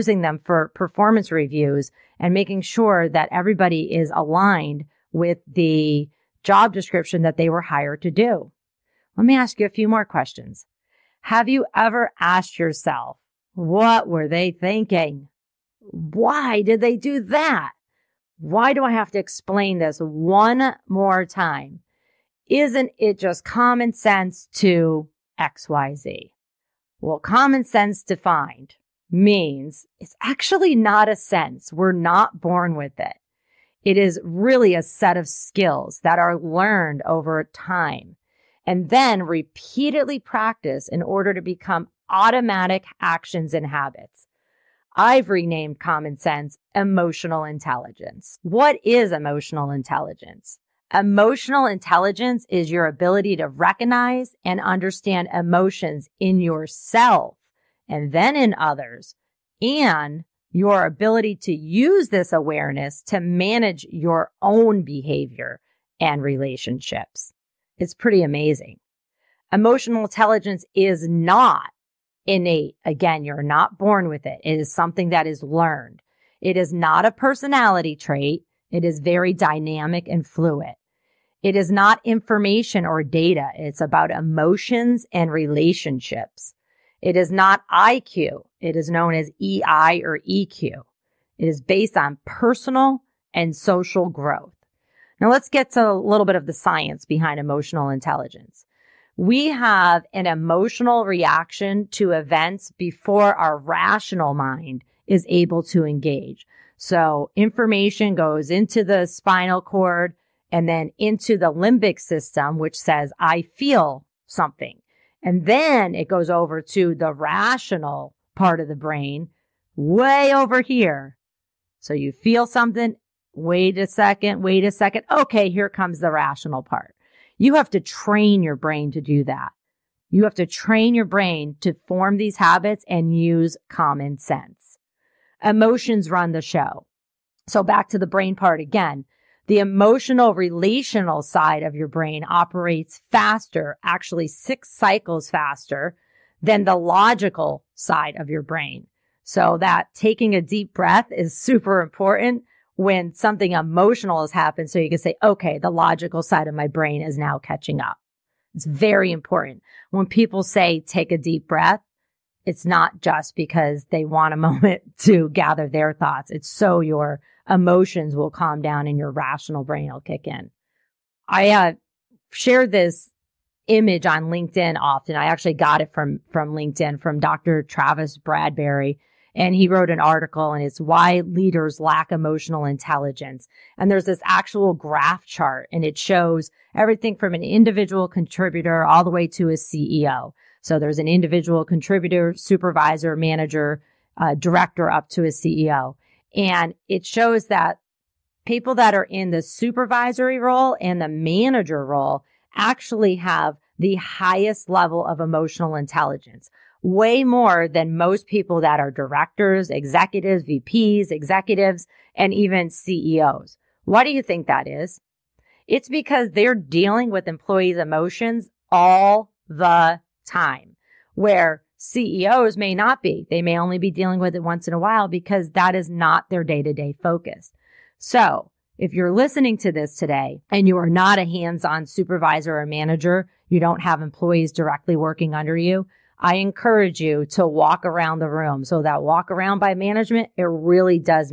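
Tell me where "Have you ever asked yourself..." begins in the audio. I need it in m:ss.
0:11.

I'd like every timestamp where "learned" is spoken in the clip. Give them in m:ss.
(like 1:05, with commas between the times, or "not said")
0:36, 1:15.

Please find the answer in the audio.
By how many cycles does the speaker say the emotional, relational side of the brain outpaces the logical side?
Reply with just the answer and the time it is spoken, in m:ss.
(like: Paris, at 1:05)
6, at 2:24.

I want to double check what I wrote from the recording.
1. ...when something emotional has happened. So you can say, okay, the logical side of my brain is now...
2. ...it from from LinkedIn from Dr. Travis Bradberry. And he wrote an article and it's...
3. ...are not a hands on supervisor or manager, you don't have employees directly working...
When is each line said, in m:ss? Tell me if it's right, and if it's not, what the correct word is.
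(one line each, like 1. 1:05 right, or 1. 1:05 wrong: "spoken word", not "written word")
1. 2:32 right
2. 2:55 right
3. 3:50 right.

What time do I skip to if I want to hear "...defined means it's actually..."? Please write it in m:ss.
0:28.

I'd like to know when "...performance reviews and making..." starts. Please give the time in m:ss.
0:00.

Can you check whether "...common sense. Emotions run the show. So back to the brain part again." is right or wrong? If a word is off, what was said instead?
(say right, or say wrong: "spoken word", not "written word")
right.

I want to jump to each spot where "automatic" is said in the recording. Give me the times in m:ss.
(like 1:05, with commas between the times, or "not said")
0:42.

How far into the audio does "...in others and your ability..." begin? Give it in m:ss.
0:58.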